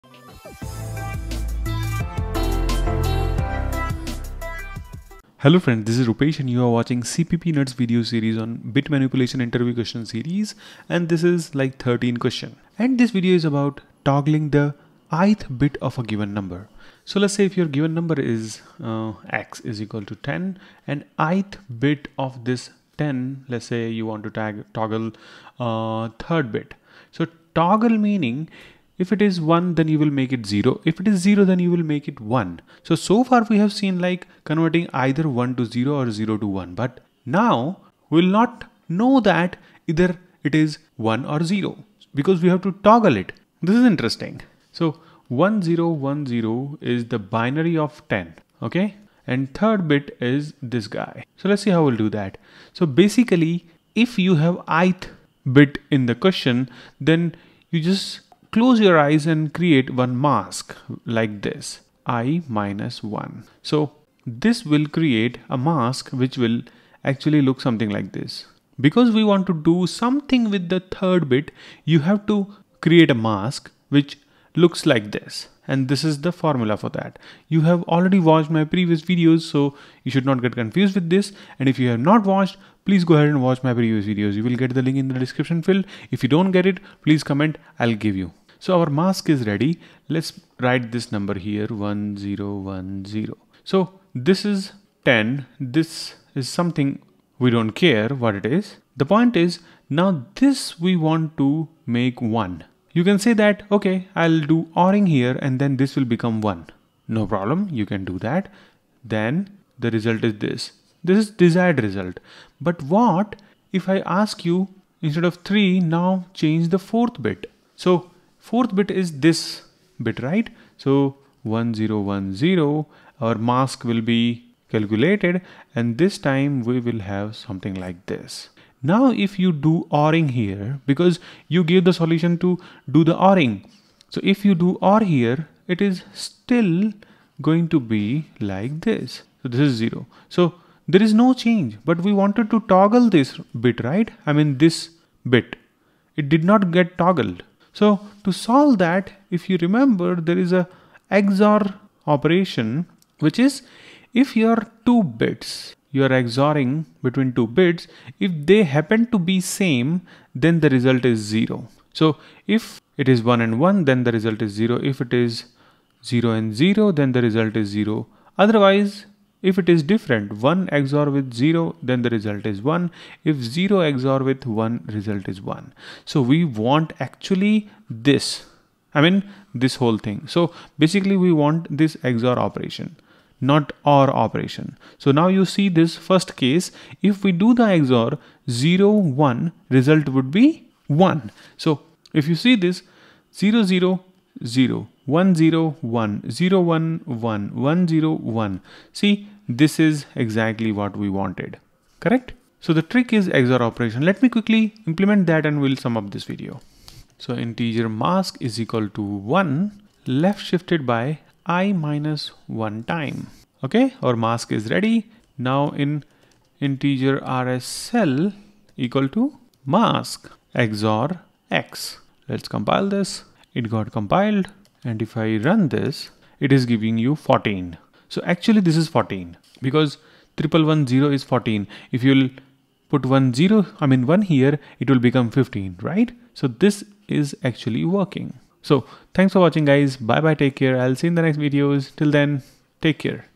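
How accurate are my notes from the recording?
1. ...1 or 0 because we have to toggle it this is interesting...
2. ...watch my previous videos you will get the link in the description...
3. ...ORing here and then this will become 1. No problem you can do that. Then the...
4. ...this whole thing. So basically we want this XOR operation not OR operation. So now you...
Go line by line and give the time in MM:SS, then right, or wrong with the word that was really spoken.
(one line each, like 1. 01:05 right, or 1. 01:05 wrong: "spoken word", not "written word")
1. 00:41 right
2. 01:23 right
3. 01:44 right
4. 02:59 right.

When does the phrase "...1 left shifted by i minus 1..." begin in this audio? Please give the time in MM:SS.
03:29.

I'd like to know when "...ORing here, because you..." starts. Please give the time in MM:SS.
02:09.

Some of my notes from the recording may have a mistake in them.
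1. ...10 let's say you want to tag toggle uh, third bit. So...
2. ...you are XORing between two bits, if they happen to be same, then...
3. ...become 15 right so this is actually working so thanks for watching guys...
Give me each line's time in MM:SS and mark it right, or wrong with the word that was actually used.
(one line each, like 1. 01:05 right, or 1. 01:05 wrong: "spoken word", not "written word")
1. 00:22 right
2. 02:35 right
3. 03:54 right.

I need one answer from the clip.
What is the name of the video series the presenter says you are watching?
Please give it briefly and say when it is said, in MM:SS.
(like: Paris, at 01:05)
CPP Nuts, at 00:07.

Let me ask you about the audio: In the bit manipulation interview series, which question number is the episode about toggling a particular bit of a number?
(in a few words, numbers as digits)
13.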